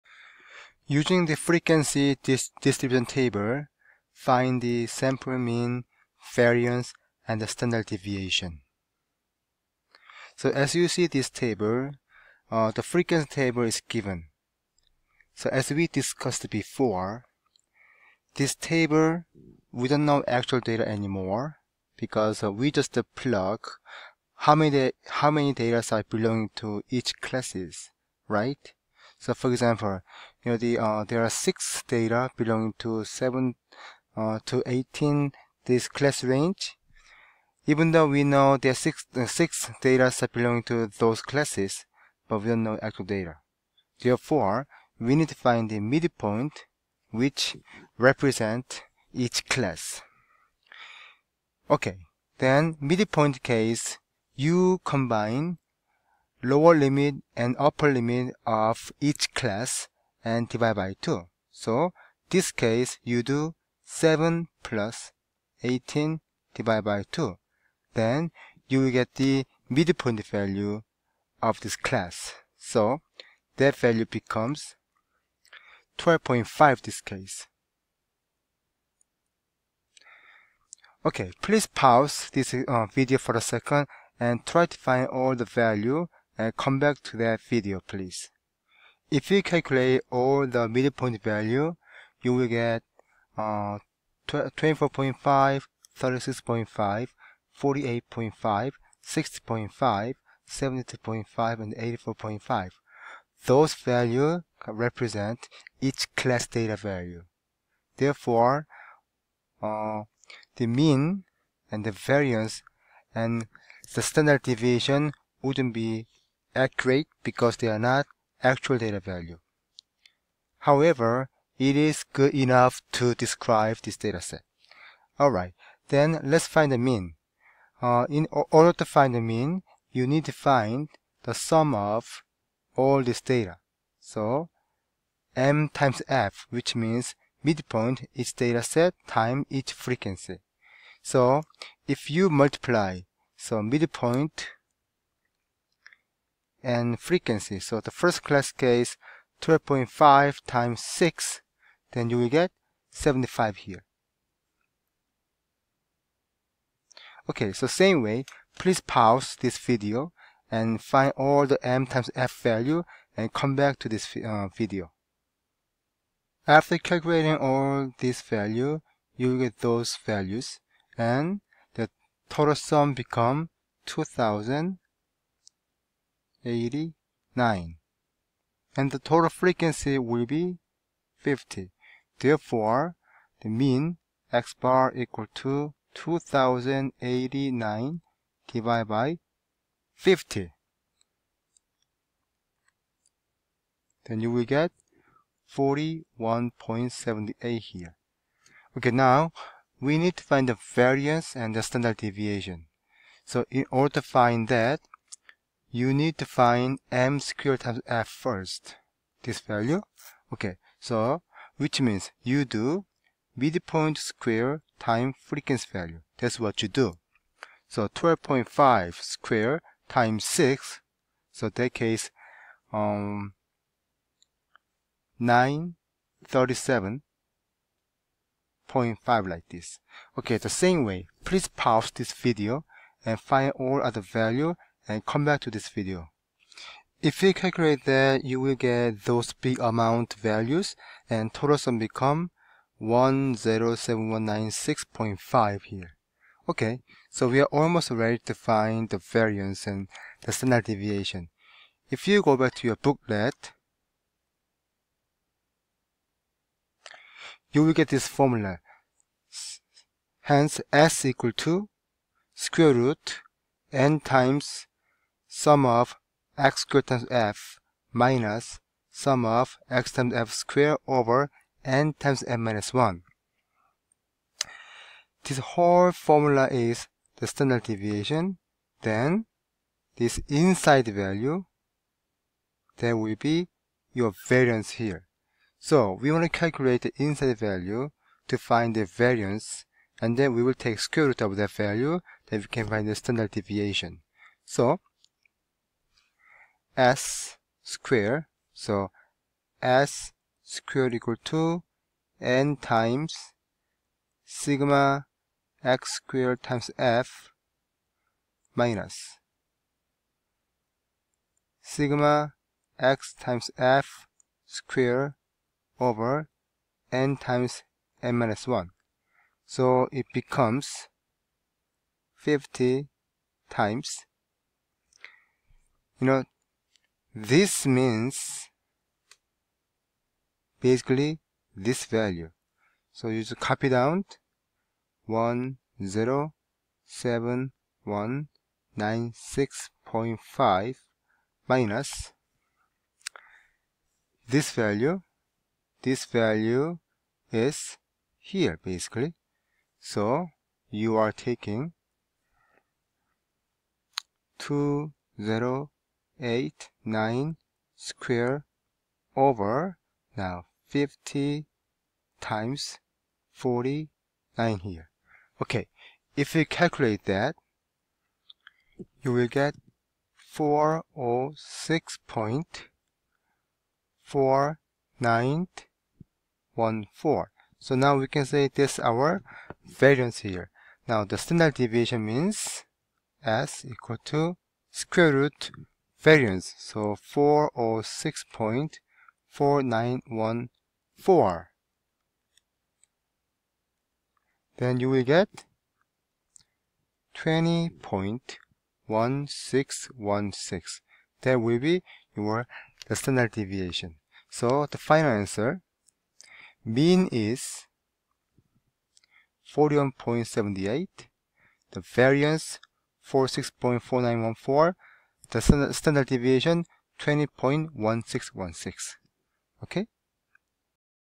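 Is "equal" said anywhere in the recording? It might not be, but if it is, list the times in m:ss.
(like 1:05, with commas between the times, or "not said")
3:04, 4:21, 5:00, 6:23.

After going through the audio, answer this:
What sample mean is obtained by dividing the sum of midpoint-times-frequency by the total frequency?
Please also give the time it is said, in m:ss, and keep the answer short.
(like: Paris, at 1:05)
41.78, at 3:15.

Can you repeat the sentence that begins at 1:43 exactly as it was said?
Those values represent each class data value.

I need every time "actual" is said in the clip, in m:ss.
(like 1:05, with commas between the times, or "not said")
0:20, 0:42, 1:58.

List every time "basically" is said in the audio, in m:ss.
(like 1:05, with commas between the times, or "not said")
5:30, 5:48.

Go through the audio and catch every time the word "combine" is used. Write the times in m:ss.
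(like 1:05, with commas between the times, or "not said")
0:54.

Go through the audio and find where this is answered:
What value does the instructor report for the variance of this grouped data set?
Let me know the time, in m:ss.
6:10.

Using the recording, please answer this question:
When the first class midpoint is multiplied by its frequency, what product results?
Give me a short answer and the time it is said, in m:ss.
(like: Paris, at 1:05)
75, at 2:32.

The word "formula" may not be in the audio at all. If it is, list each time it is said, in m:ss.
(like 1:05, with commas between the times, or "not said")
4:18, 4:35.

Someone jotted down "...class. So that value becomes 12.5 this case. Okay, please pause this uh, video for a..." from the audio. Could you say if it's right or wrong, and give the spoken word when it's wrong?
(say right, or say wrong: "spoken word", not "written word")
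right.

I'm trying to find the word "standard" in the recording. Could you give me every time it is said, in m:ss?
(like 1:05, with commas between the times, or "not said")
0:07, 1:54, 3:21, 4:10, 4:37, 4:52, 6:21, 6:55.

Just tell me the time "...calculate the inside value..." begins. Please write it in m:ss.
4:46.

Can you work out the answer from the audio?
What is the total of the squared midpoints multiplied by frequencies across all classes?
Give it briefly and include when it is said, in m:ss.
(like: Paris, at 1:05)
107,196.5, at 4:02.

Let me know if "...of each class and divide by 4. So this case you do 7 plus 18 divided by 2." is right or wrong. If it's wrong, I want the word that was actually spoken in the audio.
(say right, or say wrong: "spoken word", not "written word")
wrong: "2", not "4".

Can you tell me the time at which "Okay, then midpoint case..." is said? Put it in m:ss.
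0:51.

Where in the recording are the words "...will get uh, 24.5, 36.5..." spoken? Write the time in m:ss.
1:32.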